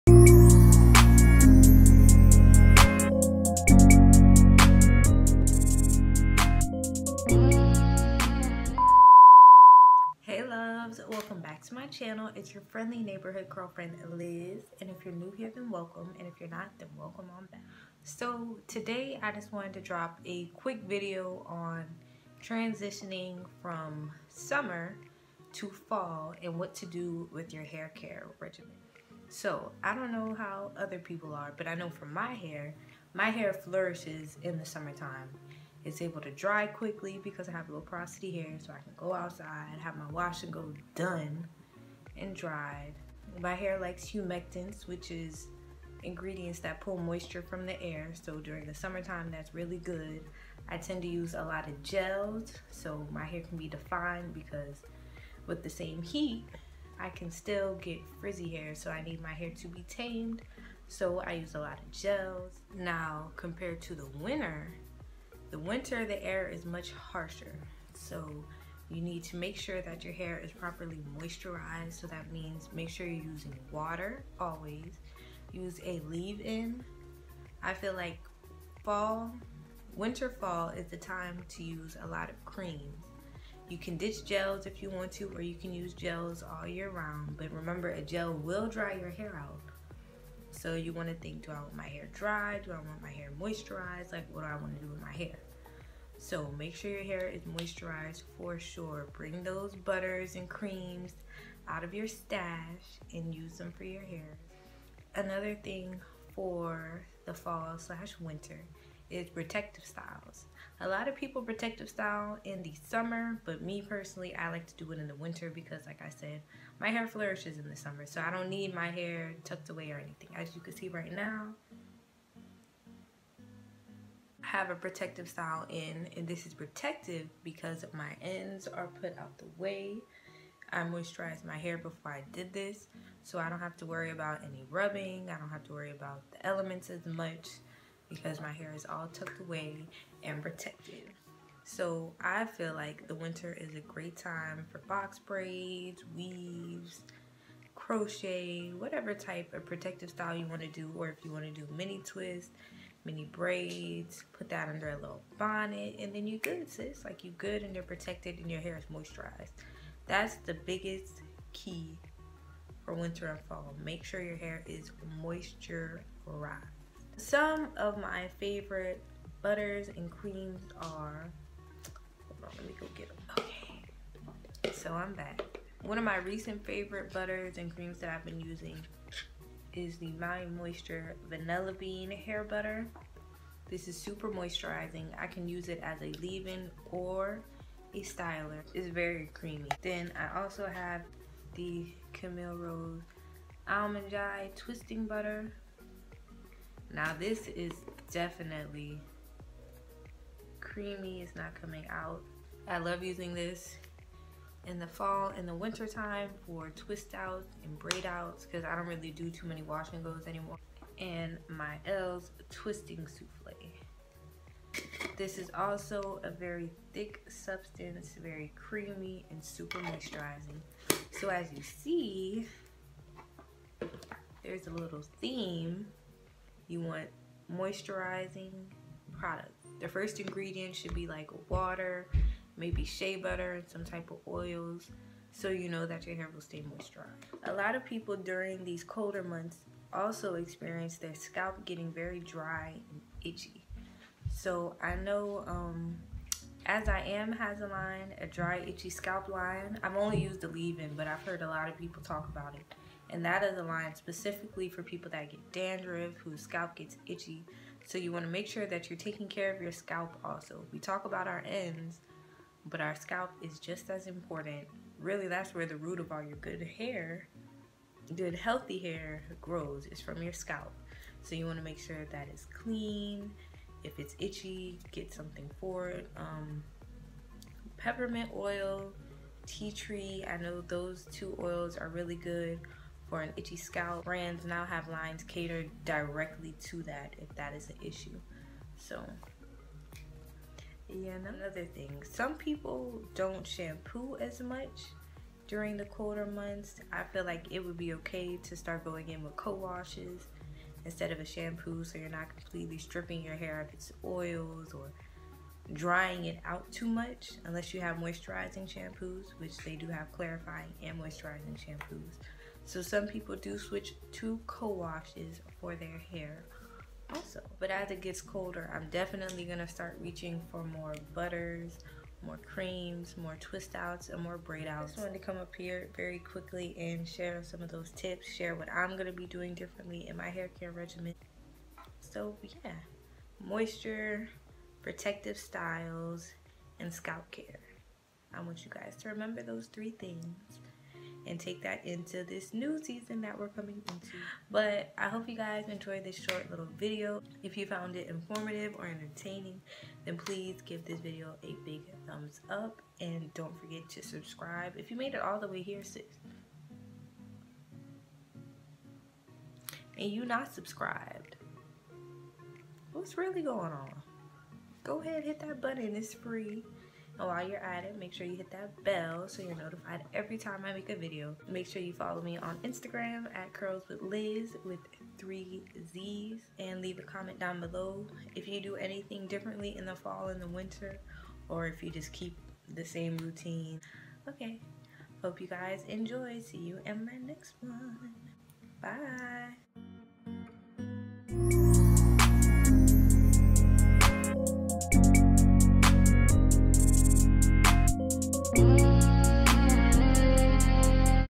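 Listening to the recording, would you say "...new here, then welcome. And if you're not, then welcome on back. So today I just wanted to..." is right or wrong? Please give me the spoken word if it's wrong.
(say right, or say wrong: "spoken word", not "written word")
right.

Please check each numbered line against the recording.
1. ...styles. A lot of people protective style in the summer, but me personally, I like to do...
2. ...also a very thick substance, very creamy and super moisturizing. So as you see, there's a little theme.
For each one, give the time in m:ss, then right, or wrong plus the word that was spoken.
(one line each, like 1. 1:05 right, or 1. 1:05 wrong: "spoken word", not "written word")
1. 1:49 right
2. 3:35 right.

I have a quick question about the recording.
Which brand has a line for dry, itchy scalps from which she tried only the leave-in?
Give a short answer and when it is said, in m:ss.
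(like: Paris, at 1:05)
As I Am, at 4:06.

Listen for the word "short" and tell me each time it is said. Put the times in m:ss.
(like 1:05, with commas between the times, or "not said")
5:46.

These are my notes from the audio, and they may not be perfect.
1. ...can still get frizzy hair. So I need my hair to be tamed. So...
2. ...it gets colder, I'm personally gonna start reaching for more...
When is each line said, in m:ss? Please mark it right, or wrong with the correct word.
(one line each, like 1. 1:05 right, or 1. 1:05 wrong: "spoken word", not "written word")
1. 0:57 right
2. 5:17 wrong: "definitely", not "personally".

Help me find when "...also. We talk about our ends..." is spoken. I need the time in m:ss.
4:20.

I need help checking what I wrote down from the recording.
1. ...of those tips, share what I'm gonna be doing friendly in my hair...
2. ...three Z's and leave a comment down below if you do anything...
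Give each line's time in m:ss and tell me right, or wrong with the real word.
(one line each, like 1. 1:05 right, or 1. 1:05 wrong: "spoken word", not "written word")
1. 5:27 wrong: "differently", not "friendly"
2. 6:15 right.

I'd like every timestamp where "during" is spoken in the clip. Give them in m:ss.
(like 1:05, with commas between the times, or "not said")
0:48, 3:58, 4:55.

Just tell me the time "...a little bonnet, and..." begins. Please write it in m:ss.
2:34.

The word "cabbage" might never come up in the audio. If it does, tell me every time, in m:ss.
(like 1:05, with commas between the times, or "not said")
not said.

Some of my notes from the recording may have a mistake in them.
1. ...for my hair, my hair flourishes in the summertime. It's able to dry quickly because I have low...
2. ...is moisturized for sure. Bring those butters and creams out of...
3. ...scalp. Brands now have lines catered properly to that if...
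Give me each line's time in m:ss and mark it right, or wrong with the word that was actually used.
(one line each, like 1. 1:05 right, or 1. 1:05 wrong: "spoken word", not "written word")
1. 0:31 right
2. 1:37 right
3. 4:43 wrong: "directly", not "properly".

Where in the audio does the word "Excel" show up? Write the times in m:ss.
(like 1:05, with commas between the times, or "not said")
not said.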